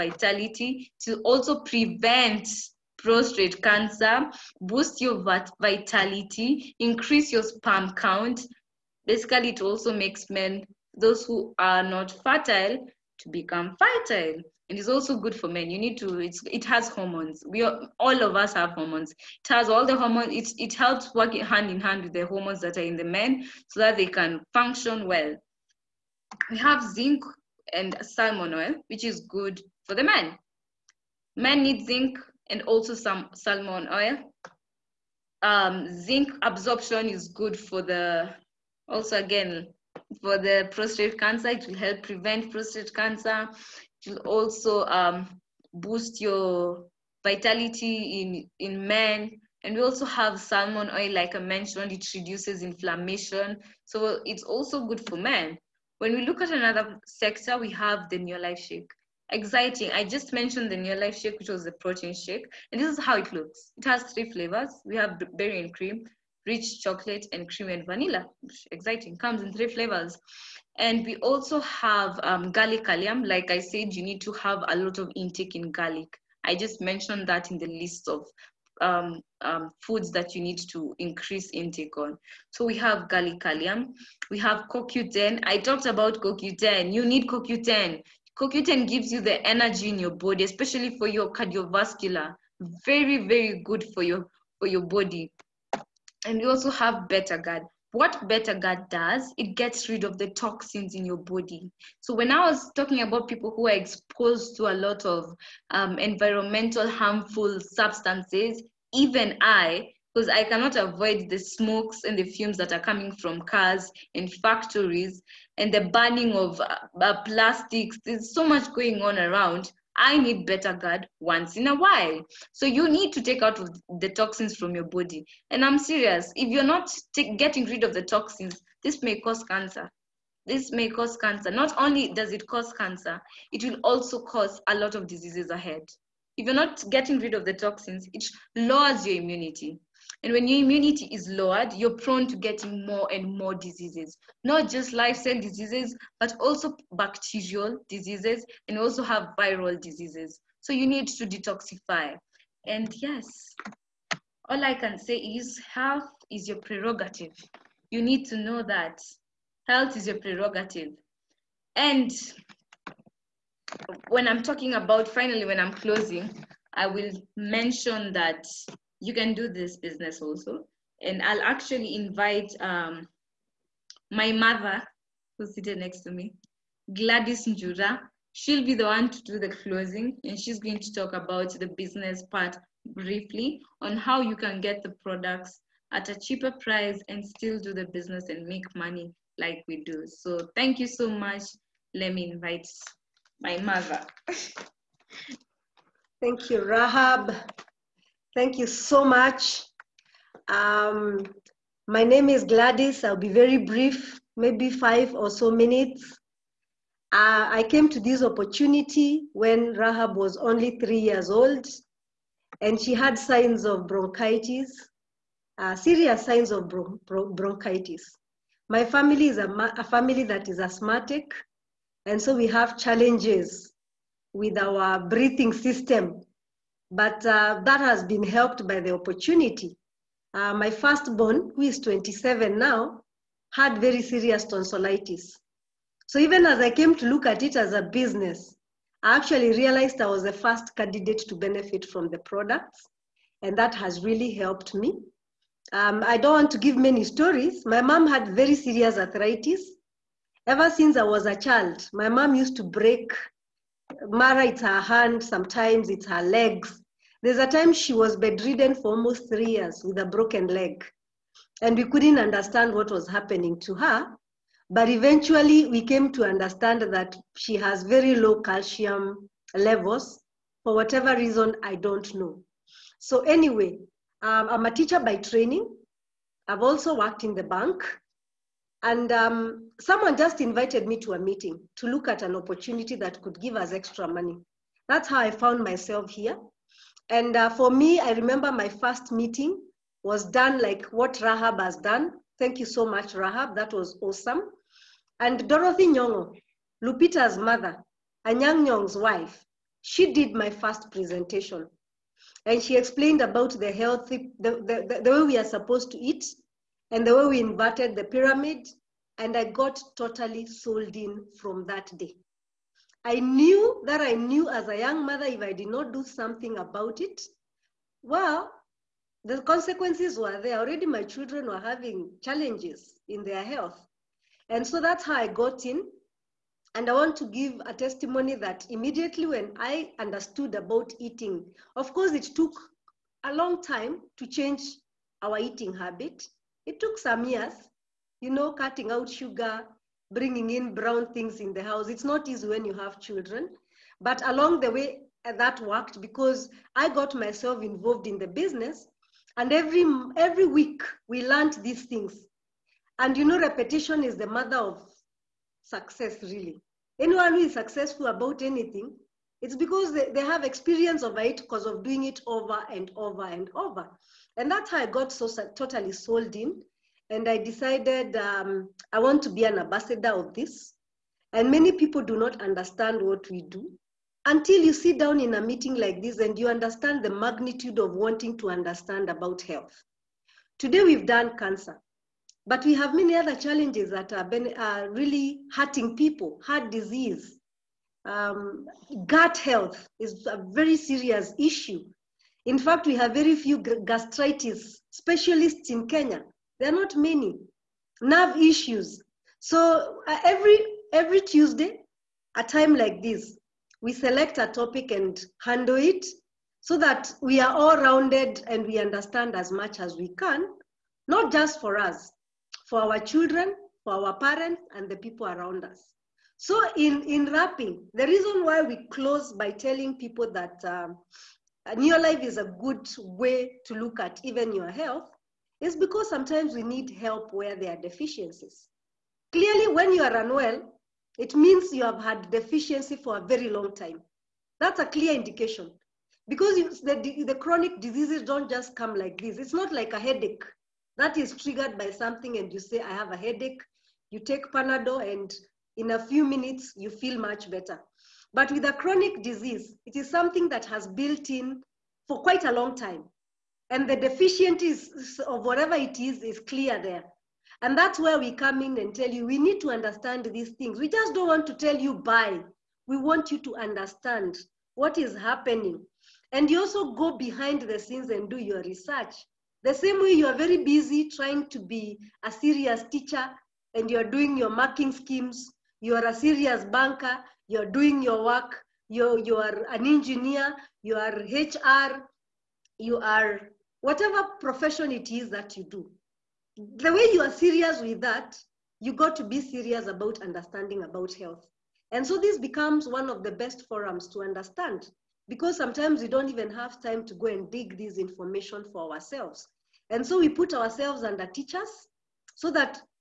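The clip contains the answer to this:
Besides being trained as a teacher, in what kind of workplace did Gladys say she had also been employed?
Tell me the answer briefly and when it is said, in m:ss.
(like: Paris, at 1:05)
The bank, at 4:37.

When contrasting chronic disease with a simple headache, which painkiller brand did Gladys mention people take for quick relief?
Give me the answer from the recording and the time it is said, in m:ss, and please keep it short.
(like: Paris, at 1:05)
Panadol, at 7:24.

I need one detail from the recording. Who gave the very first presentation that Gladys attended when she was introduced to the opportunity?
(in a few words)
Dorothy Nyong'o.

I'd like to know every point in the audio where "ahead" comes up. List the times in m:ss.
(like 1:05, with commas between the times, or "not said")
2:15.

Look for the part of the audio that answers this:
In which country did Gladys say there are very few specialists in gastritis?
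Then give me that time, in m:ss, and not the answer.
6:35.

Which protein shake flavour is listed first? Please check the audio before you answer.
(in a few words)
Berry and cream.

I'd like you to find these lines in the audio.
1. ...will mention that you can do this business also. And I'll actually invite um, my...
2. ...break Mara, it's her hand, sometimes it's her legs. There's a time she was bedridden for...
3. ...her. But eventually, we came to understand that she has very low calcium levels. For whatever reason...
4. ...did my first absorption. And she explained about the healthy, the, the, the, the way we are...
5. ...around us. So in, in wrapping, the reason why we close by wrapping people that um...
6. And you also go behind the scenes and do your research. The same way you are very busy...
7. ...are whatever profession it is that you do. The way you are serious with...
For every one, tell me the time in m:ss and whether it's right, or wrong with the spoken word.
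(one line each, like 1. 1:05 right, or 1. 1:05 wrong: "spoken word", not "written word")
1. 2:46 right
2. 4:12 right
3. 4:23 right
4. 5:00 wrong: "presentation", not "absorption"
5. 6:55 wrong: "telling", not "wrapping"
6. 7:46 right
7. 8:02 right.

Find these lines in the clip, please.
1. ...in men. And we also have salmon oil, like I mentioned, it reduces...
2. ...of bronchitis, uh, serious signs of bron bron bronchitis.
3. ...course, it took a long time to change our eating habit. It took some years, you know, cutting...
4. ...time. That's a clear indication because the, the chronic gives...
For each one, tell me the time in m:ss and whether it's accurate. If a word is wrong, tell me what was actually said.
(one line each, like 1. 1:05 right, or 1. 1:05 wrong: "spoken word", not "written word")
1. 0:48 right
2. 3:33 right
3. 5:31 right
4. 7:13 wrong: "diseases", not "gives".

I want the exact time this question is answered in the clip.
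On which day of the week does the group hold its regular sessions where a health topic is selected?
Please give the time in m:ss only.
6:41.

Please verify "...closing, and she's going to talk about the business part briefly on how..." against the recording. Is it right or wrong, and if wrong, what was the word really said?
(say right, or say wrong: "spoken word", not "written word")
right.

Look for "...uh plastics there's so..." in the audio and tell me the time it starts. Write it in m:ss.
1:57.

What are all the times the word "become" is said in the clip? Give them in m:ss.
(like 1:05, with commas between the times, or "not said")
0:13, 8:12.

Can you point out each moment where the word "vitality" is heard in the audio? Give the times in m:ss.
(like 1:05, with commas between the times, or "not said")
0:05, 0:47.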